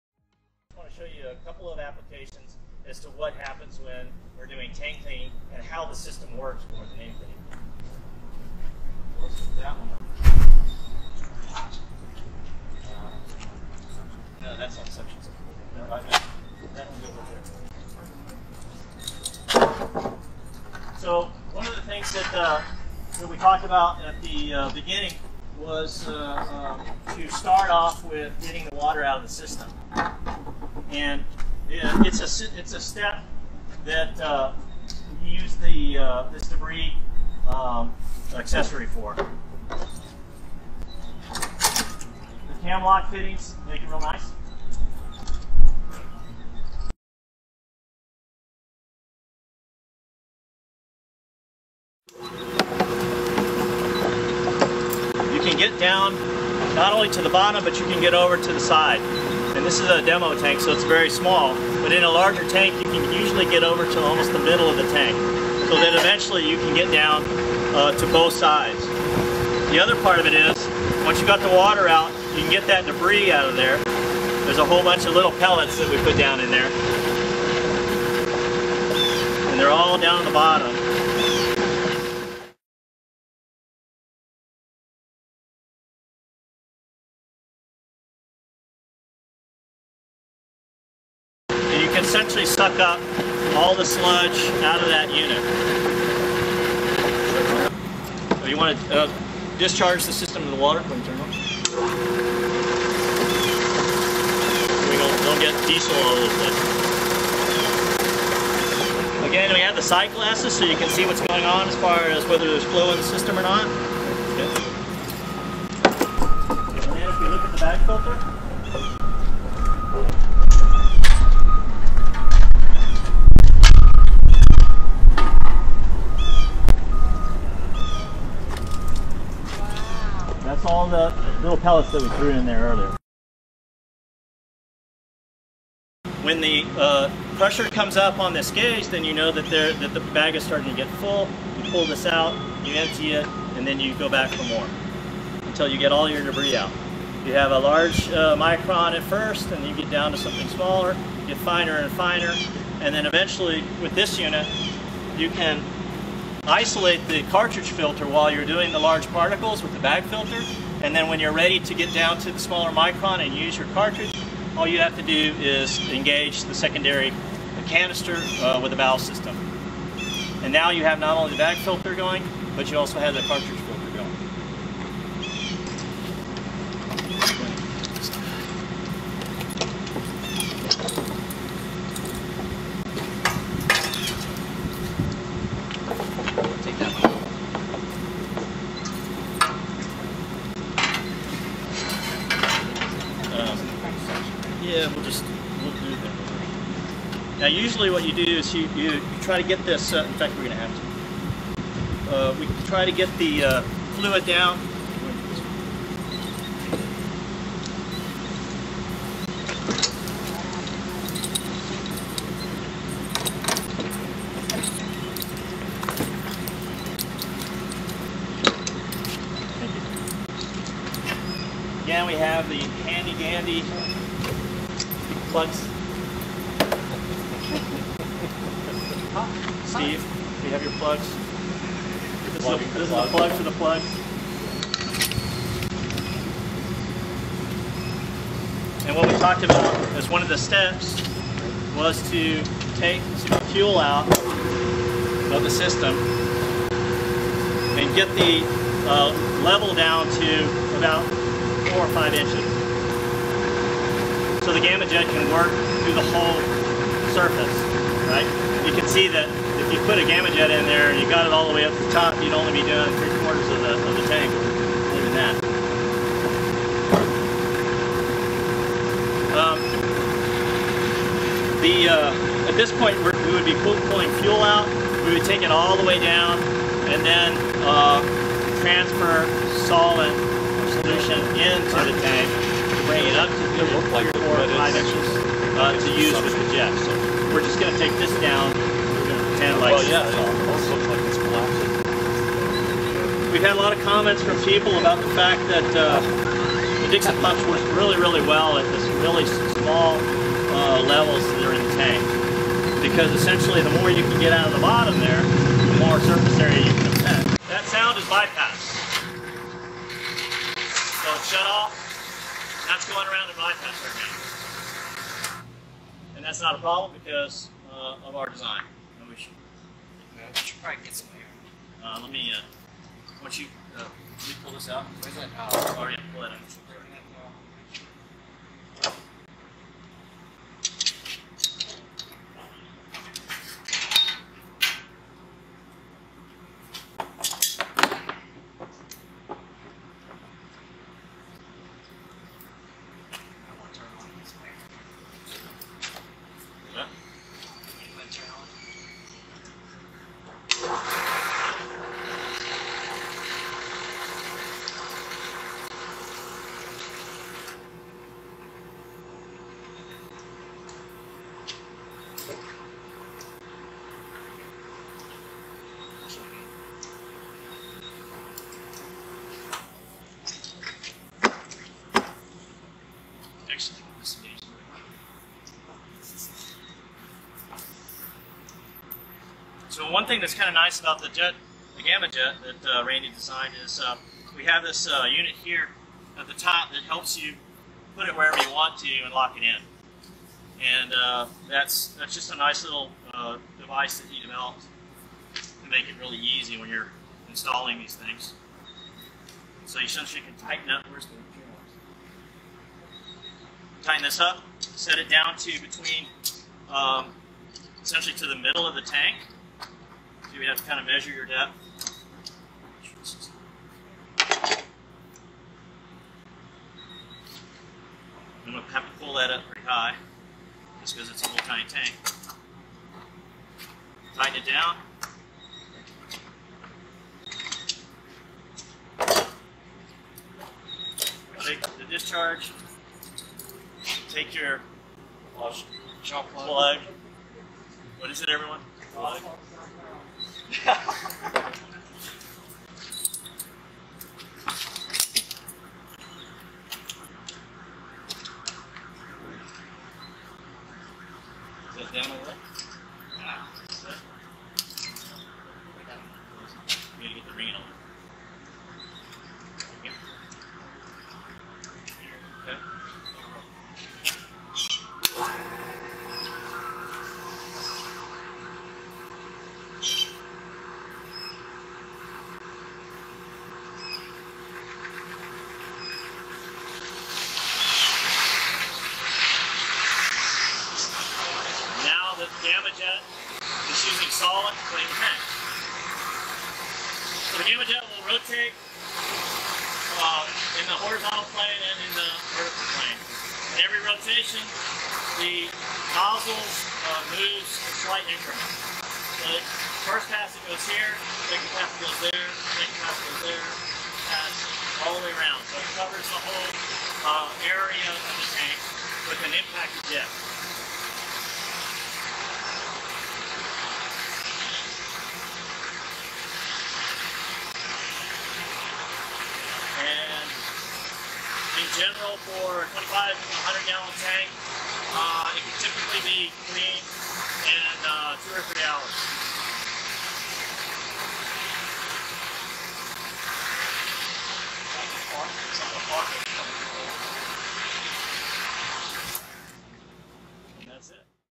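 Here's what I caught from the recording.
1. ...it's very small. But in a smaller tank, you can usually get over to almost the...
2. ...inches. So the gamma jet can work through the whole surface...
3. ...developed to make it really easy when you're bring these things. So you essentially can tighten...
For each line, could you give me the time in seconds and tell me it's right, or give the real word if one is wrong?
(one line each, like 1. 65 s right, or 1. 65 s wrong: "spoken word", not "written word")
1. 60 s wrong: "larger", not "smaller"
2. 252 s right
3. 394 s wrong: "installing", not "bring".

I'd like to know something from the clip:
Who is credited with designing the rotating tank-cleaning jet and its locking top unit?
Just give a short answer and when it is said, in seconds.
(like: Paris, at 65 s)
Randy, at 382 s.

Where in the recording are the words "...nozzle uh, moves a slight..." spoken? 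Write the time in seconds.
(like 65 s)
495 s.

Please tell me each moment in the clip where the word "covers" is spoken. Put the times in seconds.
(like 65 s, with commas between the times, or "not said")
505 s.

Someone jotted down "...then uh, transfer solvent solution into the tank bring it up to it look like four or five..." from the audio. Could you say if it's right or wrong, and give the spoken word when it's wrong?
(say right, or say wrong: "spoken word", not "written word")
right.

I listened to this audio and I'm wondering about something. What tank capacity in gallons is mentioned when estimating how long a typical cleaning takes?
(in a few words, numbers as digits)
2500 gallons.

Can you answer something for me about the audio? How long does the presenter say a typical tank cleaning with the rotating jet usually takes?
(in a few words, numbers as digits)
2 or 3 hours.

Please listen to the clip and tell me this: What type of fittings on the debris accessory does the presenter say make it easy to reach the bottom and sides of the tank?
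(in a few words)
Cam lock fittings.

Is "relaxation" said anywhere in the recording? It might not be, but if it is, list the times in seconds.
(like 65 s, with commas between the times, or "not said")
not said.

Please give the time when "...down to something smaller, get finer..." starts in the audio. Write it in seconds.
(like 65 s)
149 s.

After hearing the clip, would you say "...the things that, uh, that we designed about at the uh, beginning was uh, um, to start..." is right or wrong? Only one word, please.
wrong.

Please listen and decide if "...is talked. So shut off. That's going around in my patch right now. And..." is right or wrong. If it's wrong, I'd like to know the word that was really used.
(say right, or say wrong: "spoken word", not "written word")
wrong: "bypassed", not "talked".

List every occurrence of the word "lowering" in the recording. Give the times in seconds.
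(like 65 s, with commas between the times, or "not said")
not said.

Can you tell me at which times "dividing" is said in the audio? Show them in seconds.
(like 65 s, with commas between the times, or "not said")
not said.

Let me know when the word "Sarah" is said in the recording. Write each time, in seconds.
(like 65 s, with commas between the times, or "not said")
not said.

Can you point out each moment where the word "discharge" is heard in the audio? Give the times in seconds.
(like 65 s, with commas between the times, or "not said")
99 s, 431 s.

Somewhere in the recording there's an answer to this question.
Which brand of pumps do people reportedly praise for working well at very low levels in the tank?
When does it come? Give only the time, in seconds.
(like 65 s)
296 s.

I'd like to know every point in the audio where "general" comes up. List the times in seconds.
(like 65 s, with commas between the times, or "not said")
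521 s.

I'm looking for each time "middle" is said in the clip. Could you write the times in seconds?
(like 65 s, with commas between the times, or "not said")
64 s, 408 s.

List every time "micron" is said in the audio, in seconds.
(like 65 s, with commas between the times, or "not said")
148 s, 162 s.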